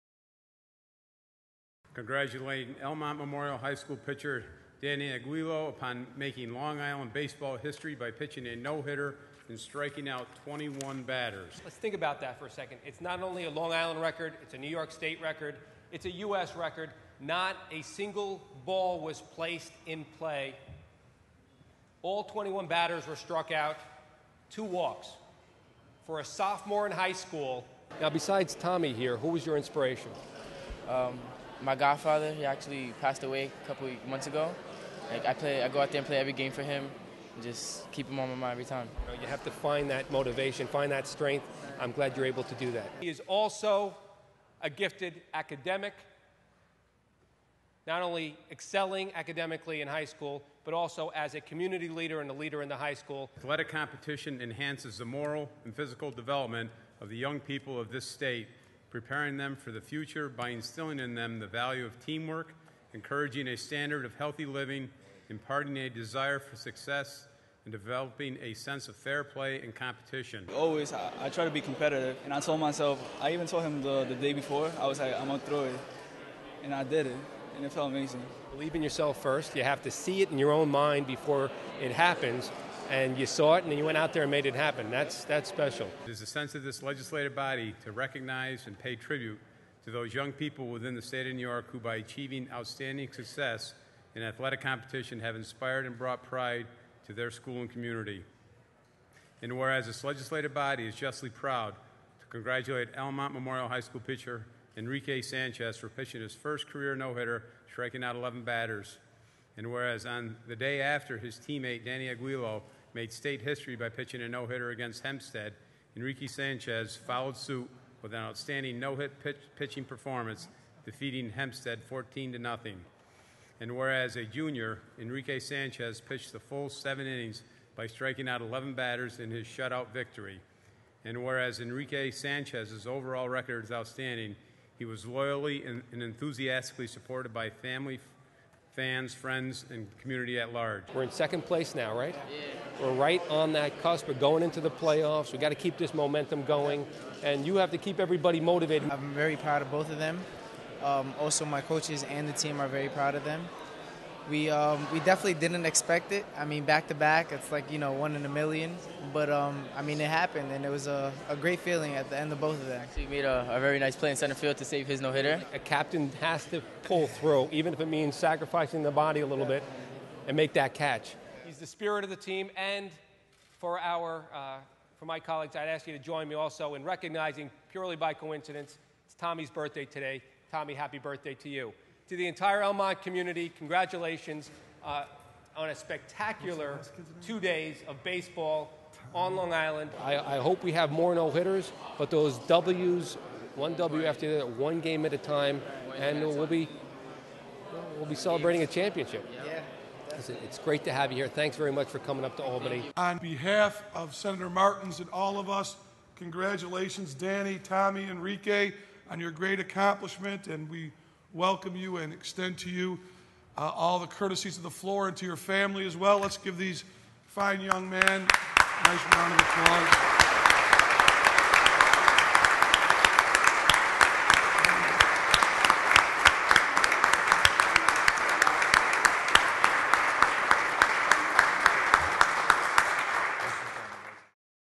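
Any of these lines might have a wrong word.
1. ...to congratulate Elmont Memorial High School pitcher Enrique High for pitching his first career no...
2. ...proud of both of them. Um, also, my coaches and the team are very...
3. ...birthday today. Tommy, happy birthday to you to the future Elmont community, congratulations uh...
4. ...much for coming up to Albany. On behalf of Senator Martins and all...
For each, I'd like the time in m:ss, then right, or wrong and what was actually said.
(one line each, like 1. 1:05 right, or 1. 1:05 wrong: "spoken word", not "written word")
1. 1:42 wrong: "Sanchez", not "High"
2. 2:29 right
3. 2:59 wrong: "entire", not "future"
4. 3:21 right.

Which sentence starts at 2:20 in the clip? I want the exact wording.
We're in second place now, right?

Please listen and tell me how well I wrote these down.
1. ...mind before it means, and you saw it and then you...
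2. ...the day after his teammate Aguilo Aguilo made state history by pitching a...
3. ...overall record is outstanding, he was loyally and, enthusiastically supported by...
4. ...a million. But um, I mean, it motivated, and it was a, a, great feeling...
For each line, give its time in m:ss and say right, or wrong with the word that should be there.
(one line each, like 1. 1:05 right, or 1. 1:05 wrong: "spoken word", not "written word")
1. 1:20 wrong: "happens", not "means"
2. 1:50 wrong: "Danny", not "Aguilo"
3. 2:12 right
4. 2:38 wrong: "happened", not "motivated".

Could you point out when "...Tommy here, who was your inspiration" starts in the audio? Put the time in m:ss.
0:28.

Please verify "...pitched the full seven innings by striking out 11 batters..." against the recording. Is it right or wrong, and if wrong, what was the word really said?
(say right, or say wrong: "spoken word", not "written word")
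right.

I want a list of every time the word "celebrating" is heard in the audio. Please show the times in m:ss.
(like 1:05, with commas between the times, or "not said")
3:18.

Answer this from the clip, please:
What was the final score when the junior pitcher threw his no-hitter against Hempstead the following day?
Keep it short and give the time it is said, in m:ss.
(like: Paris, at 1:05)
14-0, at 2:01.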